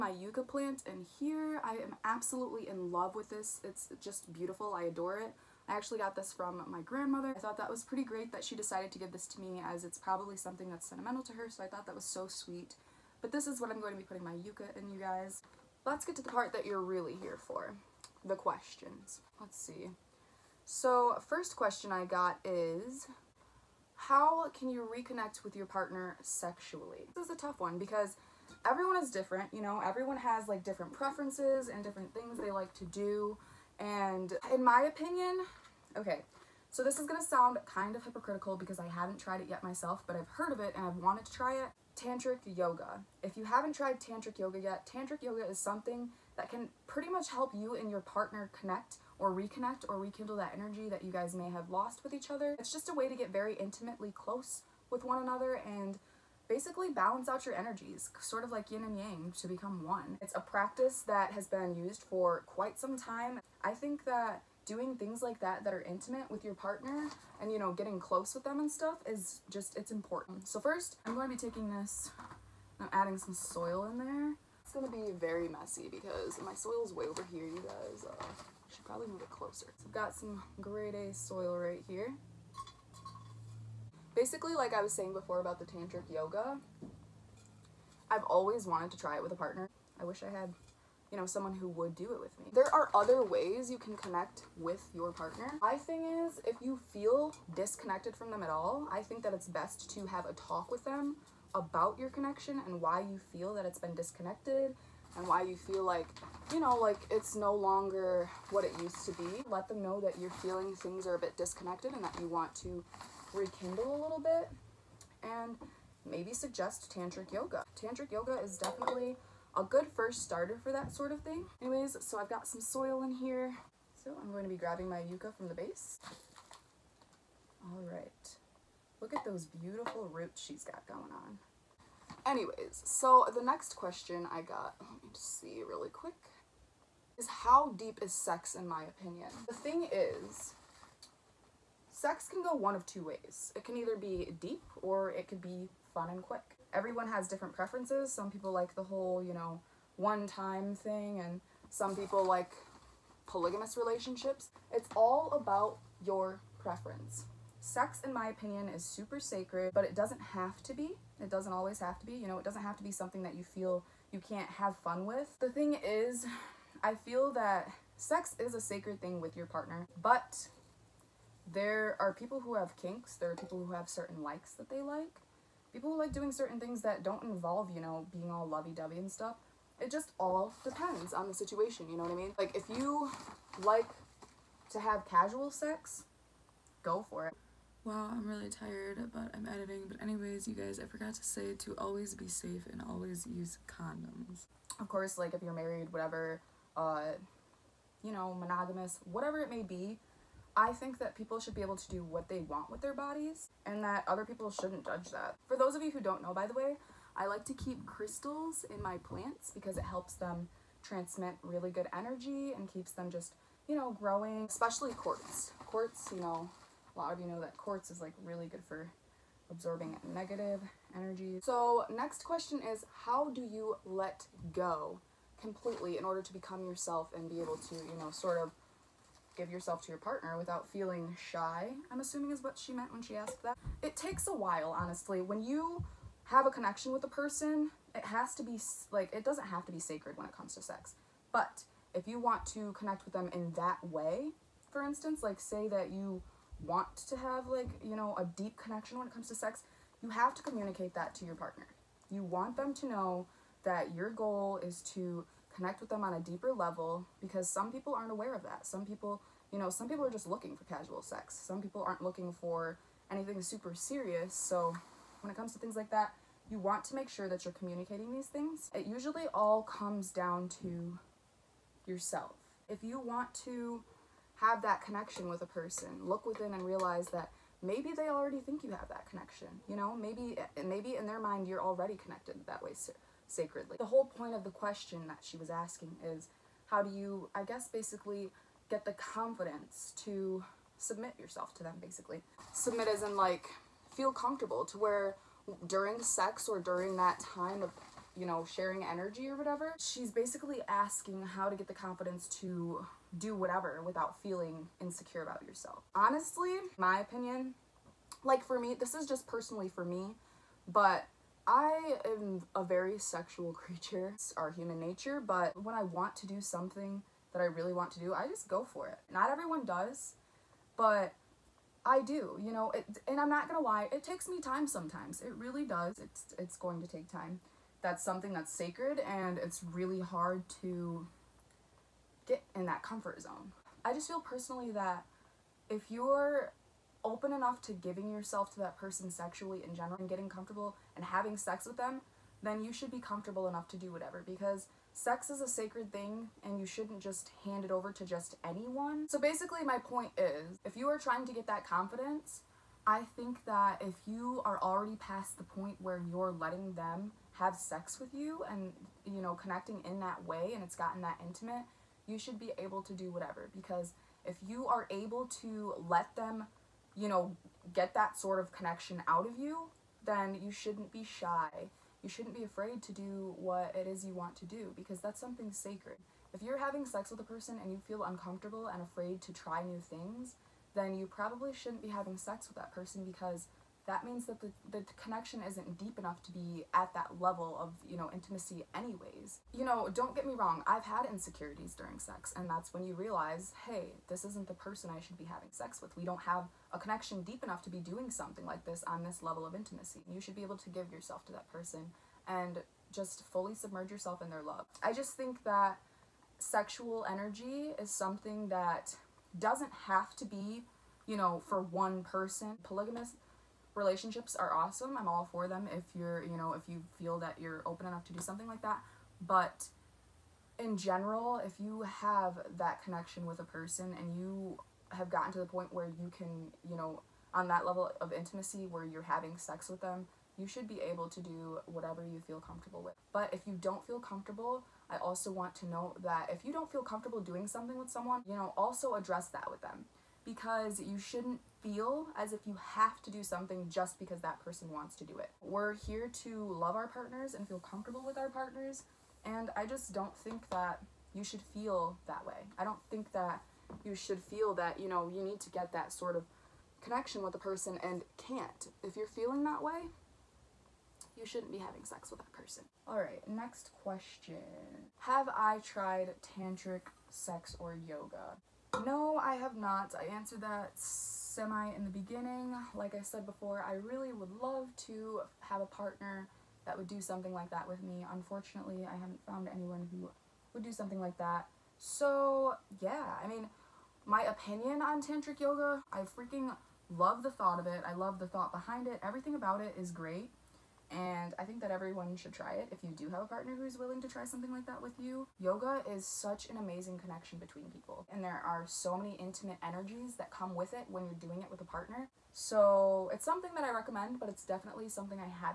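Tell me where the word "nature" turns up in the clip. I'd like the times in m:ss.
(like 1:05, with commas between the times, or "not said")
5:14.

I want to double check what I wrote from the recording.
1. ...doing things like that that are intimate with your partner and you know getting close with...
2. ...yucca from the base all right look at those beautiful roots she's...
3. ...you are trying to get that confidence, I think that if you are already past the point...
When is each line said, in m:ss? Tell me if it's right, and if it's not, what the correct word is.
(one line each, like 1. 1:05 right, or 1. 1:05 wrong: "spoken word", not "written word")
1. 1:04 right
2. 2:05 right
3. 5:50 right.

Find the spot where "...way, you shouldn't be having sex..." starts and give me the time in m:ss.
7:39.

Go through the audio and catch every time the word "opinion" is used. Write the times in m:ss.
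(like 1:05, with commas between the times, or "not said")
0:34, 2:18, 2:38, 5:06, 8:04.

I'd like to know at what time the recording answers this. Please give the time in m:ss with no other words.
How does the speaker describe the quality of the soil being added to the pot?
1:20.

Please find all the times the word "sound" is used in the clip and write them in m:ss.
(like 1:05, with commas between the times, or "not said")
0:37.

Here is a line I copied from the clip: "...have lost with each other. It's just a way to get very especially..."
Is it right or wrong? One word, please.
wrong.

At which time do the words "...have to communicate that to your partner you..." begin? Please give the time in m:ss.
4:10.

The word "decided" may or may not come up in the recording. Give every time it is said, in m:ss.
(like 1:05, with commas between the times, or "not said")
0:08.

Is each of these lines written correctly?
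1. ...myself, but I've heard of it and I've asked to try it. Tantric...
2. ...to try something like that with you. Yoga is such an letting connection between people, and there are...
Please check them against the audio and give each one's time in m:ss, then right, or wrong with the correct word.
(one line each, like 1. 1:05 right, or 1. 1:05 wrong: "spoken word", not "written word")
1. 0:39 wrong: "wanted", not "asked"
2. 8:14 wrong: "amazing", not "letting".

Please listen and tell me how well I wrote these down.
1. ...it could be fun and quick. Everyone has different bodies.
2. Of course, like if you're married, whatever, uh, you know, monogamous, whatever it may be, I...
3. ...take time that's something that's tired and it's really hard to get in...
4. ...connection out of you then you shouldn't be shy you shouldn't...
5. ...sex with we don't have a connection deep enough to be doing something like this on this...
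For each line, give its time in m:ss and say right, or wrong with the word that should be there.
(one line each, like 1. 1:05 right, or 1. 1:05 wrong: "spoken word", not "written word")
1. 2:25 wrong: "preferences", not "bodies"
2. 3:14 right
3. 5:26 wrong: "sacred", not "tired"
4. 6:08 right
5. 6:35 right.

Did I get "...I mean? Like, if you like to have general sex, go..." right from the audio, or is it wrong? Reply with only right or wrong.
wrong.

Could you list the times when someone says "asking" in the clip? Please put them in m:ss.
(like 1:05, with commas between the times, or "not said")
4:45, 5:00.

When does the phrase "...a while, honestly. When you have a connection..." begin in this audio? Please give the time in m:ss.
3:54.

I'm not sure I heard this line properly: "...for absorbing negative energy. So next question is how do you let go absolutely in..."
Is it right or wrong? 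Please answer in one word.
wrong.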